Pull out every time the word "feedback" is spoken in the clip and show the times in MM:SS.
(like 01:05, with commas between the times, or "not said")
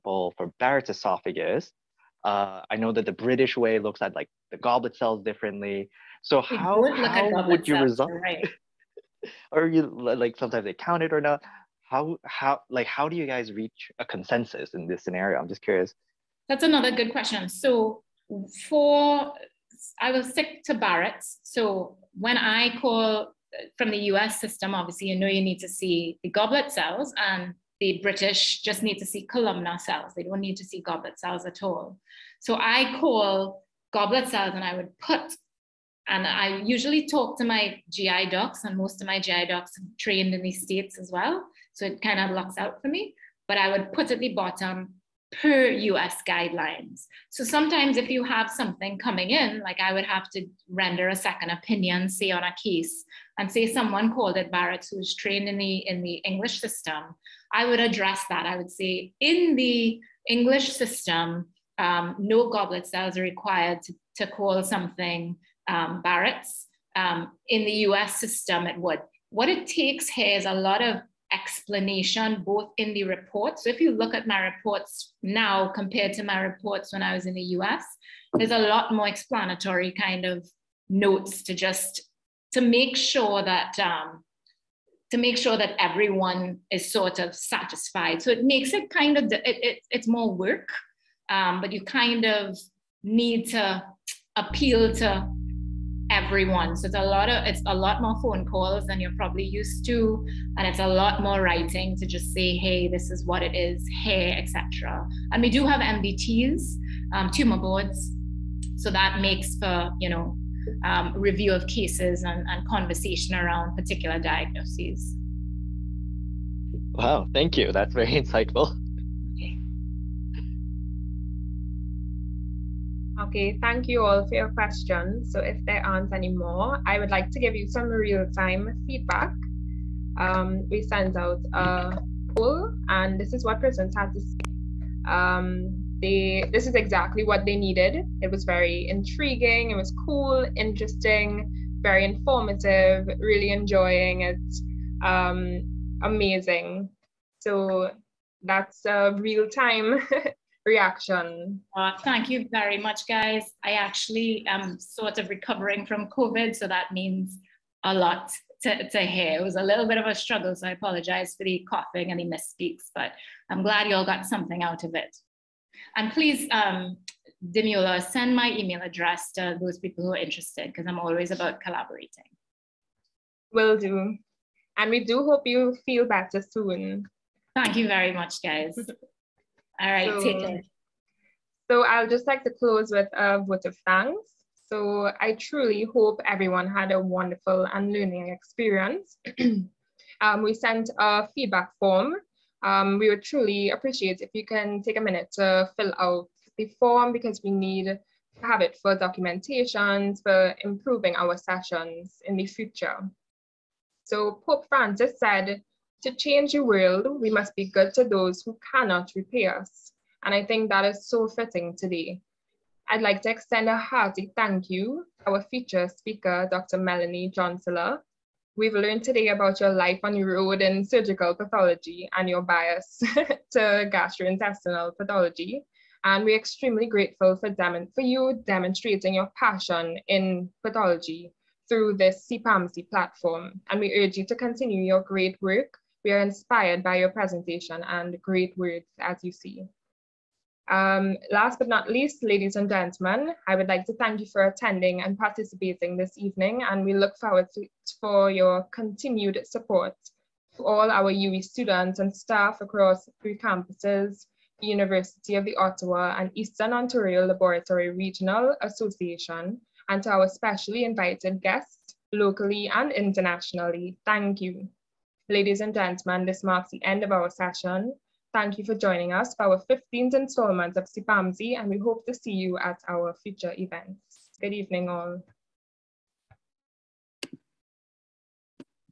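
02:08, 03:11.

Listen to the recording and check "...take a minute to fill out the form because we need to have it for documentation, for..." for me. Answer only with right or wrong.
right.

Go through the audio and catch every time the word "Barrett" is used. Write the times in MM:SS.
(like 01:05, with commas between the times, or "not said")
00:00, 00:20, 00:54, 01:06.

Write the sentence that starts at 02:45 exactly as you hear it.
And please, um, Demula, send my email address to those people who are interested because I'm always about collaborating.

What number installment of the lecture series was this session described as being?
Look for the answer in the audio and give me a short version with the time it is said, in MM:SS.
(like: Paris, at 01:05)
15th, at 04:29.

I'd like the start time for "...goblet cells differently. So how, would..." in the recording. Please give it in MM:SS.
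00:04.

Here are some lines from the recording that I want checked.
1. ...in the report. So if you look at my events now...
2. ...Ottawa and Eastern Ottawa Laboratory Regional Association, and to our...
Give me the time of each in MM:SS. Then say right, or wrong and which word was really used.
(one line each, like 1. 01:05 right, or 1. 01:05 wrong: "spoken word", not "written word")
1. 01:12 wrong: "reports", not "events"
2. 04:15 wrong: "Ontario", not "Ottawa".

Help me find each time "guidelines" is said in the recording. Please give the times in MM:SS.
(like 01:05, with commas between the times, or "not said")
00:46.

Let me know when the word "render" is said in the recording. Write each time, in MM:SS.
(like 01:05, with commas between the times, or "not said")
00:50.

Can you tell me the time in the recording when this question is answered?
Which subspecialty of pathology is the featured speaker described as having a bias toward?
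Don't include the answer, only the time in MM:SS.
03:43.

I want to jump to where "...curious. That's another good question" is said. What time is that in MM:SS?
00:15.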